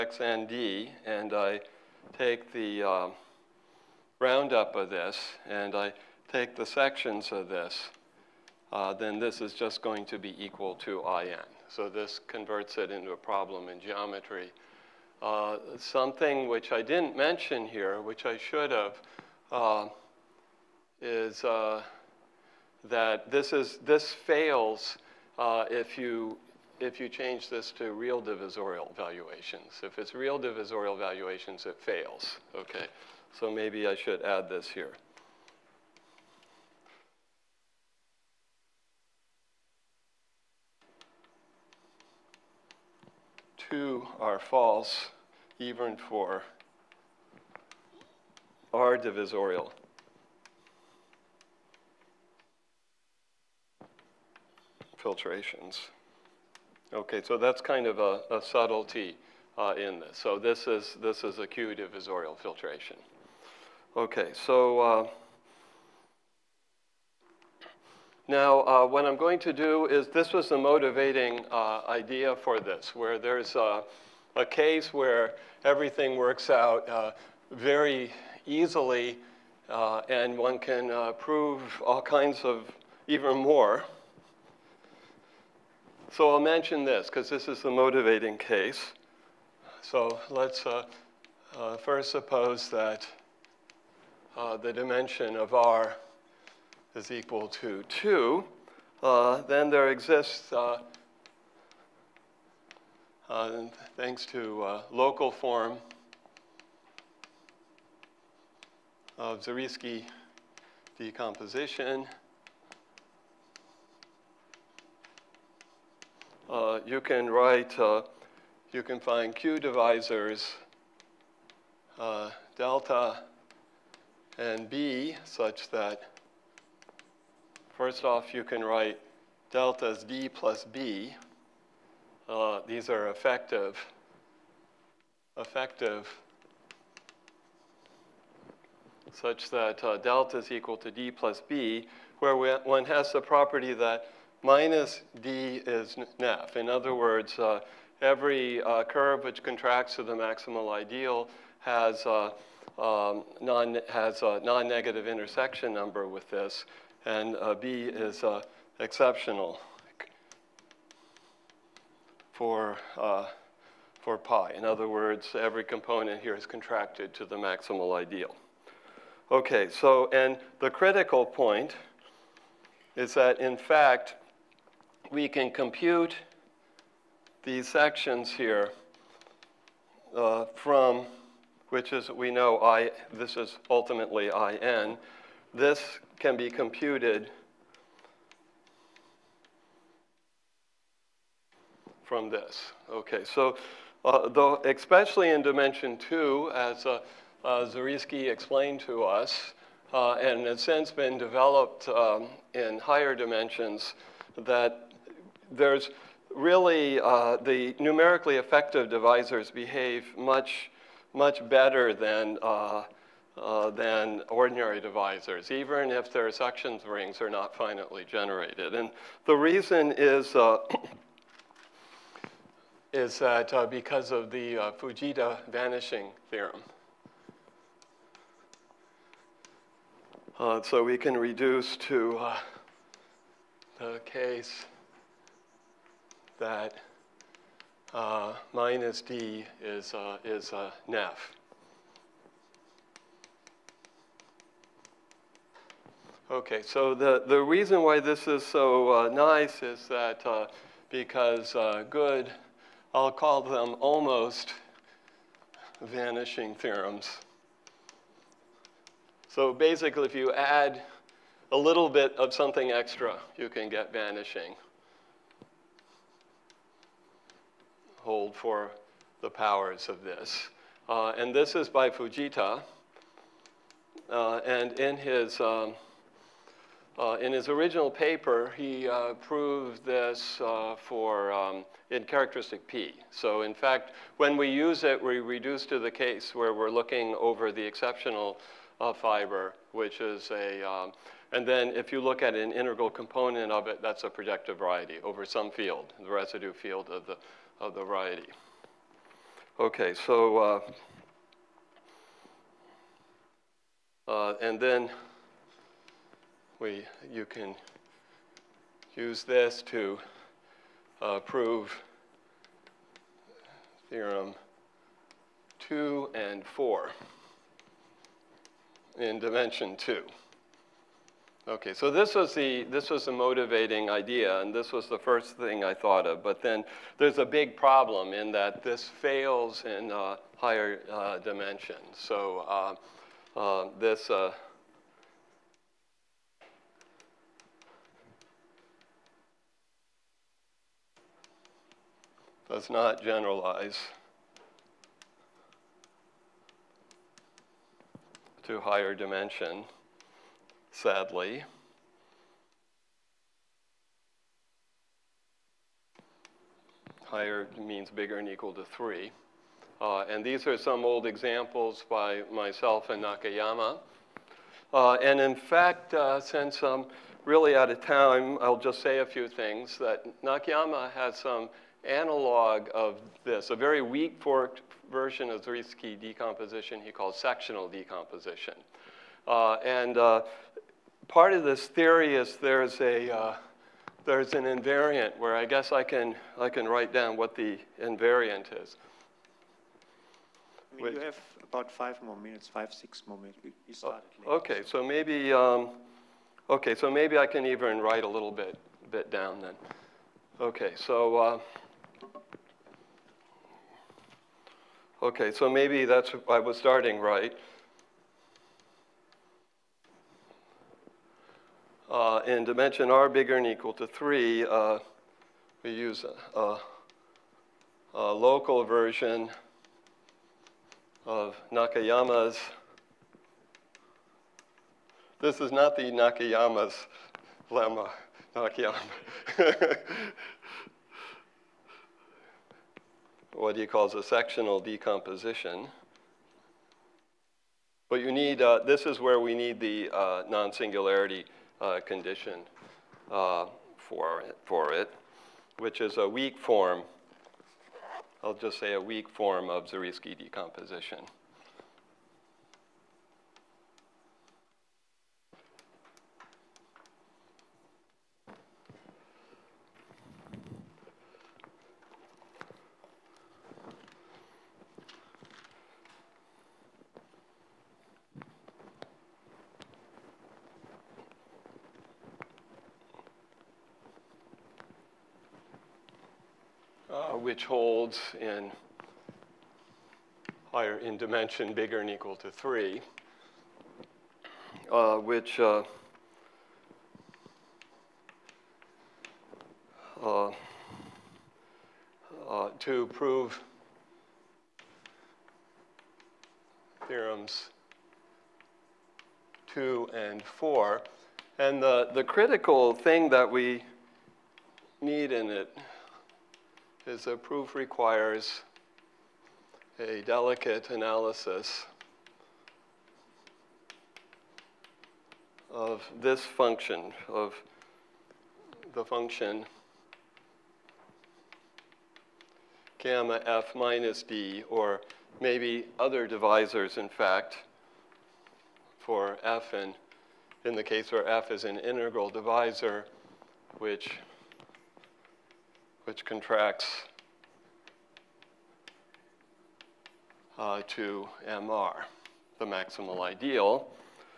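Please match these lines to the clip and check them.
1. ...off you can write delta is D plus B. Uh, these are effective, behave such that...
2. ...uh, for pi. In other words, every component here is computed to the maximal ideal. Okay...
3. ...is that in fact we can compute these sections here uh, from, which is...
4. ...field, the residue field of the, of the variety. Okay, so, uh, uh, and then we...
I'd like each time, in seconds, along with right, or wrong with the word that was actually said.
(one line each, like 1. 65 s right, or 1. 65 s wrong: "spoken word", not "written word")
1. 128 s wrong: "effective", not "behave"
2. 163 s wrong: "contracted", not "computed"
3. 172 s right
4. 295 s right.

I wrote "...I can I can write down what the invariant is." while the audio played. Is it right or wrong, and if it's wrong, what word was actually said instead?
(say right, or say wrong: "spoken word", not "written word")
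right.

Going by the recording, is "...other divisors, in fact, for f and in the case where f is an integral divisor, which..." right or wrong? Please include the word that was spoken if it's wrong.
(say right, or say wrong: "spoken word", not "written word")
right.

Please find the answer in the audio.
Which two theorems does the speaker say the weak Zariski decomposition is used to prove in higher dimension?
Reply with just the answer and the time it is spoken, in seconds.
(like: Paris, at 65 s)
Theorems 2 and 4, at 496 s.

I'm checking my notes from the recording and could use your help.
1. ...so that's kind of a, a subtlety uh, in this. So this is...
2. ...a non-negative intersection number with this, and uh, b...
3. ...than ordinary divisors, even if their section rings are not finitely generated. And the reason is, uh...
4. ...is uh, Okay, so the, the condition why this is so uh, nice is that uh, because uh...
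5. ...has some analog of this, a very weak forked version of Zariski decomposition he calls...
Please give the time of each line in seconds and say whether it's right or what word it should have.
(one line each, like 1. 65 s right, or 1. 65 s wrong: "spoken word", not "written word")
1. 57 s right
2. 154 s right
3. 213 s right
4. 240 s wrong: "reason", not "condition"
5. 370 s right.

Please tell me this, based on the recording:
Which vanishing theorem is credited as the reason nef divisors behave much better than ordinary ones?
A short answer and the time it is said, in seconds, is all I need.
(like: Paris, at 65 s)
Fujita vanishing theorem, at 224 s.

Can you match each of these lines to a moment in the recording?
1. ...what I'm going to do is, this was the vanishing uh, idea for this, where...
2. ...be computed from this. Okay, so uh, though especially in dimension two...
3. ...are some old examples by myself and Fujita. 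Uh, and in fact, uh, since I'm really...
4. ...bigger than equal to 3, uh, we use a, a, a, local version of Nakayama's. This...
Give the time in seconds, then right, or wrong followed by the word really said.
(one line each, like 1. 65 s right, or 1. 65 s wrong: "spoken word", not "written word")
1. 68 s wrong: "motivating", not "vanishing"
2. 186 s right
3. 360 s wrong: "Nakayama", not "Fujita"
4. 413 s right.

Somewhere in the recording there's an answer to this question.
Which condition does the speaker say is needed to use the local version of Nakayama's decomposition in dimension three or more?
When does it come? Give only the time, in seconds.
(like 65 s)
440 s.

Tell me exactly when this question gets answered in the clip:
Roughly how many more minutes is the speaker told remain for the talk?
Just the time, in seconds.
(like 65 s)
392 s.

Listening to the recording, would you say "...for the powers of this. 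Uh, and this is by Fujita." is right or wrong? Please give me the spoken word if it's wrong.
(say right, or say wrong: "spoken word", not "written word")
right.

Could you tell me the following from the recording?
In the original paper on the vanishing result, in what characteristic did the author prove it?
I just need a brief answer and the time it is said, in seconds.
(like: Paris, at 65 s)
Characteristic P, at 282 s.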